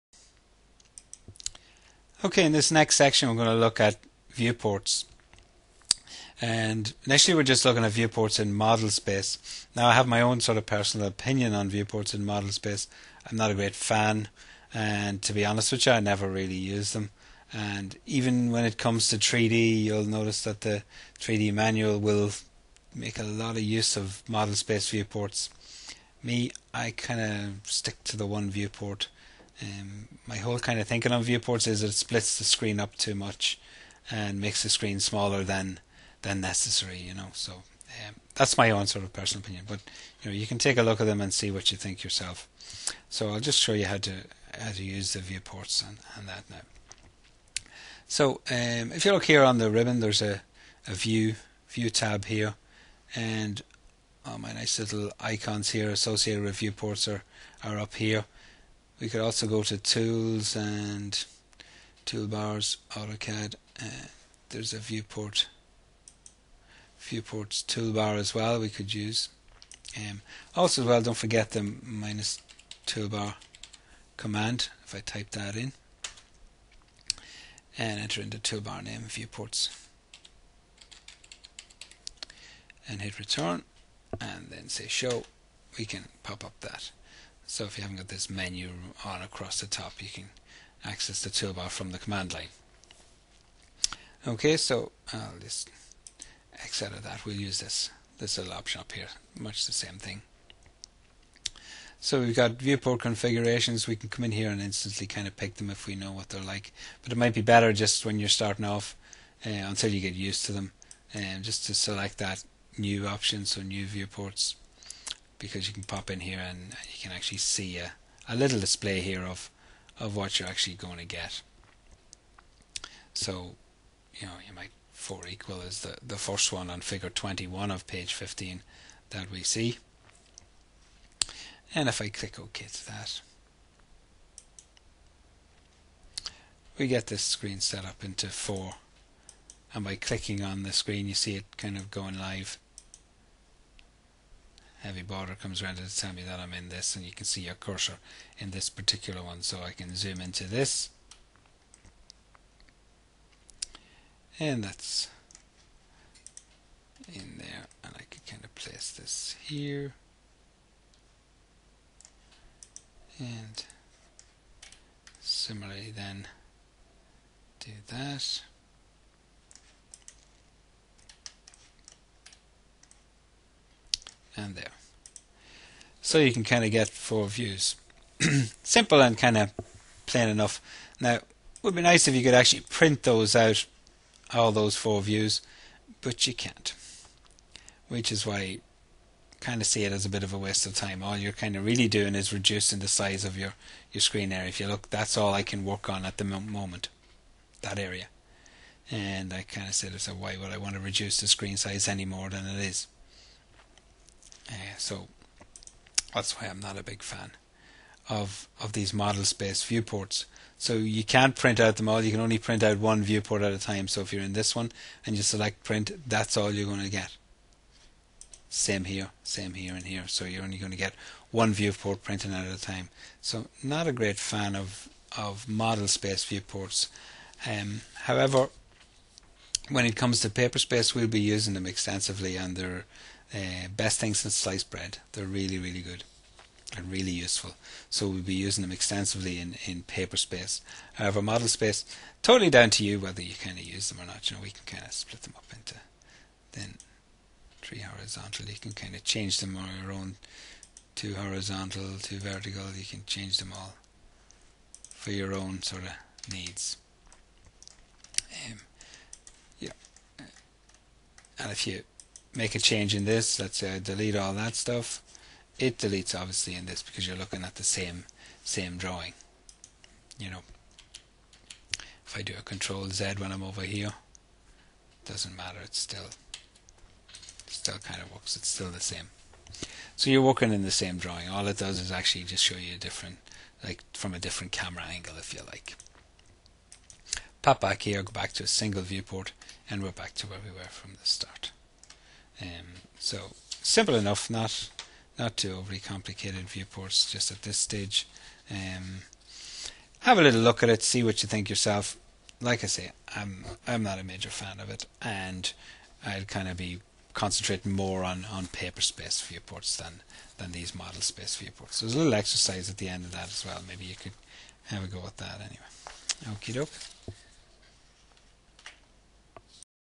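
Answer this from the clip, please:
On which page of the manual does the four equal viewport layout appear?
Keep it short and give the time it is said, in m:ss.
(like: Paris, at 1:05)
15, at 2:07.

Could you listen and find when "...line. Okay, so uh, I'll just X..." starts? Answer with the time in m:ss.
1:32.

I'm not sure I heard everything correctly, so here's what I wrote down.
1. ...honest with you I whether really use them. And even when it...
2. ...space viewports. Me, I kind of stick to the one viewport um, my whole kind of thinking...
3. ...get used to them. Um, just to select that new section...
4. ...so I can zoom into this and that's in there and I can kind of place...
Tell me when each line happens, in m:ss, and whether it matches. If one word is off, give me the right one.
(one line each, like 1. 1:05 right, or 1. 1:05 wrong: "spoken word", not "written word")
1. 0:15 wrong: "never", not "whether"
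2. 0:24 right
3. 1:49 wrong: "option", not "section"
4. 2:29 right.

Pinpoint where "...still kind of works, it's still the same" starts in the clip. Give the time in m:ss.
4:37.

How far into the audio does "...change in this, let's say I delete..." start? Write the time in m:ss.
4:22.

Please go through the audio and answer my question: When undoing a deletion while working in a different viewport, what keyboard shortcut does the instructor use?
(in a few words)
Control Z.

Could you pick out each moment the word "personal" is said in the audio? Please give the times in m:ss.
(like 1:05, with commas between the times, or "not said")
0:10, 0:39.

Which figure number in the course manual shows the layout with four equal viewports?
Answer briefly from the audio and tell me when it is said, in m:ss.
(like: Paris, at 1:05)
21, at 2:06.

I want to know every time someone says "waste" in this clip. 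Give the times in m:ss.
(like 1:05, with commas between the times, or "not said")
3:10.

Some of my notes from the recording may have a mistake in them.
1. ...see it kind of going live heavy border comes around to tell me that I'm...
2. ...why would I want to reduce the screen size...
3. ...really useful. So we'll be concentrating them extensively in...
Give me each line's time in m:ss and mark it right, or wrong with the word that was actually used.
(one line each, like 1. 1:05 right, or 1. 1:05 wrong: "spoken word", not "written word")
1. 2:21 right
2. 3:20 right
3. 3:56 wrong: "using", not "concentrating".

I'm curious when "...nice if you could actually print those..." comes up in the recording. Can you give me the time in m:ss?
3:01.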